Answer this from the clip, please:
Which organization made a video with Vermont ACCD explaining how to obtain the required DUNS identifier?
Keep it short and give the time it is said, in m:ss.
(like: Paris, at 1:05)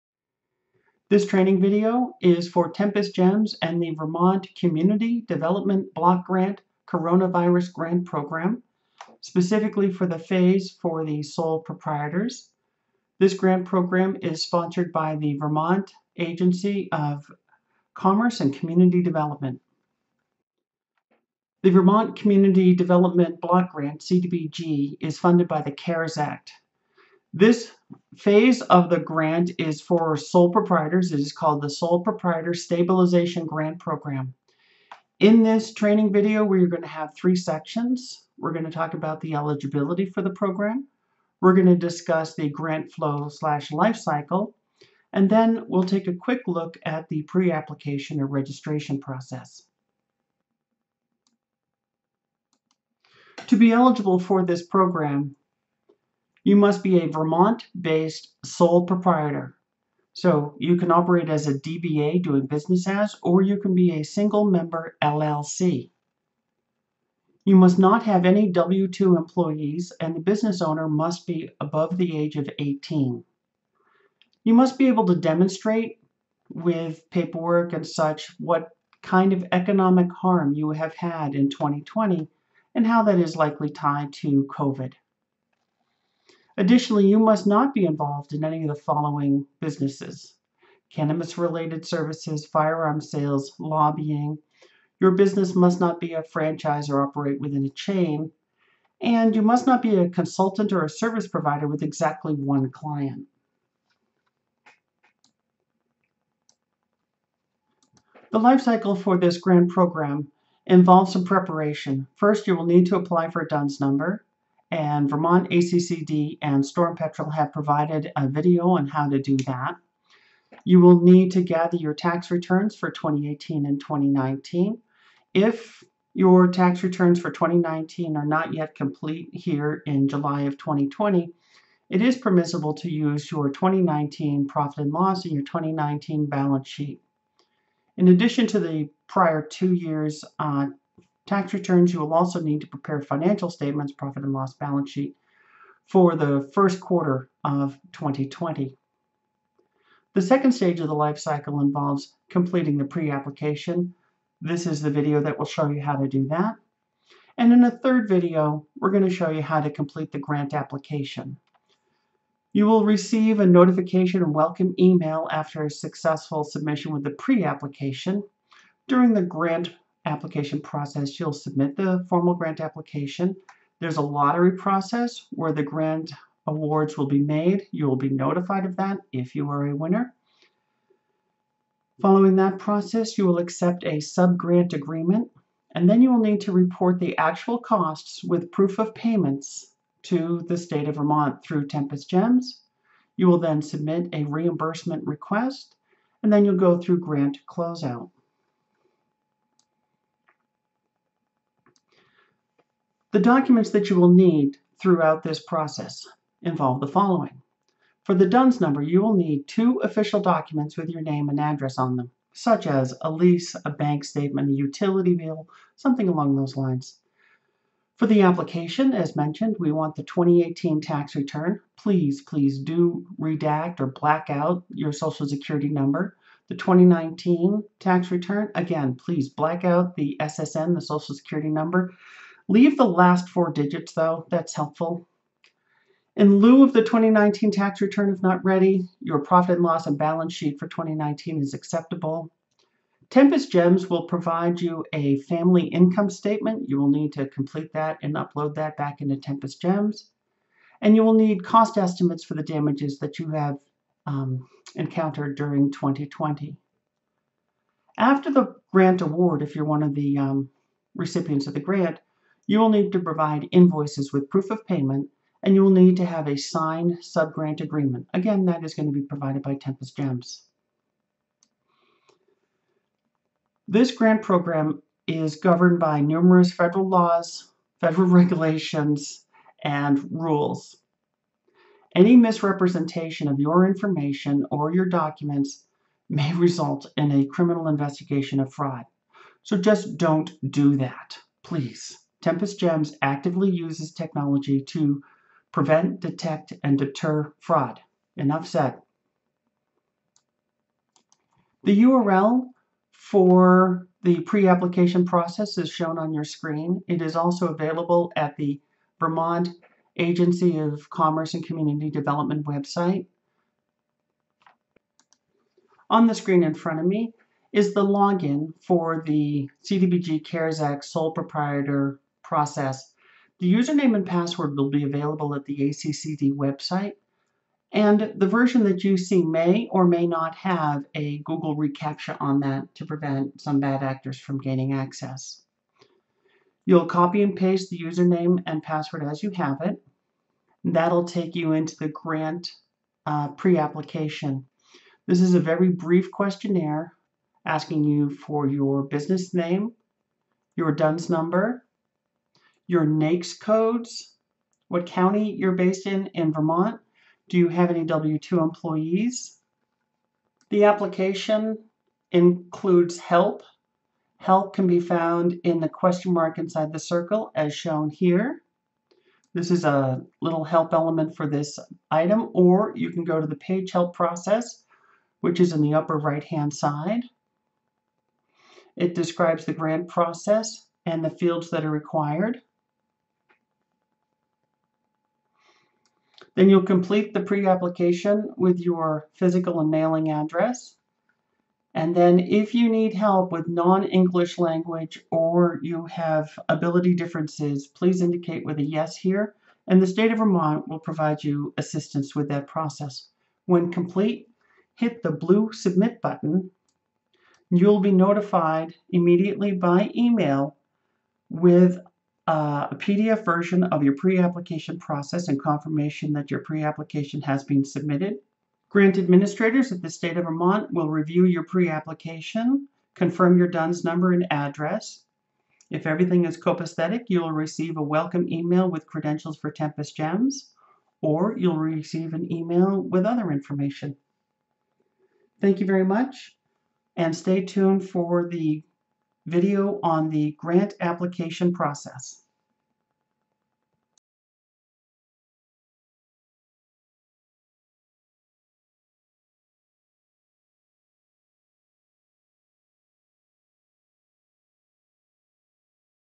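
Storm Petrel, at 1:56.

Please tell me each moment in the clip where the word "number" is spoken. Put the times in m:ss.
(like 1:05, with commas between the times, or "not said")
1:53, 3:28, 3:45, 3:51, 5:51, 7:03.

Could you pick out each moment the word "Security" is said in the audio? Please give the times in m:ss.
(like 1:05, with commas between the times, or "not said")
3:45, 3:51.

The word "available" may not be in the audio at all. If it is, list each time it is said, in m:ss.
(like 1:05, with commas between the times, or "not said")
5:07, 5:24.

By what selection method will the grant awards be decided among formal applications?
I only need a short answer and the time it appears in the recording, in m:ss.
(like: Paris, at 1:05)
A lottery, at 2:54.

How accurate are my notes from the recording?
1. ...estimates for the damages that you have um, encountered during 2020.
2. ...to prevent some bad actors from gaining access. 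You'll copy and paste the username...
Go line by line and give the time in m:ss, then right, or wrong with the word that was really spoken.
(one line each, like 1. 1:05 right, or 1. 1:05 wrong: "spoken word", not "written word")
1. 4:11 right
2. 5:32 right.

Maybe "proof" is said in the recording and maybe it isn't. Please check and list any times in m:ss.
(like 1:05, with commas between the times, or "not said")
3:08, 4:24.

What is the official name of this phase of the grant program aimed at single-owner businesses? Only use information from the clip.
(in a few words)
Sole Proprietor Stabilization Grant Program.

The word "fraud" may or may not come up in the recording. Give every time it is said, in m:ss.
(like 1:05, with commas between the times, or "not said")
4:48, 4:57.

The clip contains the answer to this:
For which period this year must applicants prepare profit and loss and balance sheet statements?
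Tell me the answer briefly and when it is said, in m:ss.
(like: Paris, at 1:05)
First quarter of 2020, at 2:26.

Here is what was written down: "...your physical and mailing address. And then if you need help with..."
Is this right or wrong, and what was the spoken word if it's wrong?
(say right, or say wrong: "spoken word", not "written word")
right.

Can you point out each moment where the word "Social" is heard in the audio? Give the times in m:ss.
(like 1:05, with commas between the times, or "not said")
3:44, 3:50.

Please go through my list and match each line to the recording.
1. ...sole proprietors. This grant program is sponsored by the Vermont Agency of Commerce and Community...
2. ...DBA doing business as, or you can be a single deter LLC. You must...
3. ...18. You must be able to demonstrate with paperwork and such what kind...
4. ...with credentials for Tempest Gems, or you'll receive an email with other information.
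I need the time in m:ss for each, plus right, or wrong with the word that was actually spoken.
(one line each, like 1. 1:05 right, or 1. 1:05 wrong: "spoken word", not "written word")
1. 0:11 right
2. 1:01 wrong: "member", not "deter"
3. 1:12 right
4. 7:08 right.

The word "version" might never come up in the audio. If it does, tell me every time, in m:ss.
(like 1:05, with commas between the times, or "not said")
5:28, 6:53.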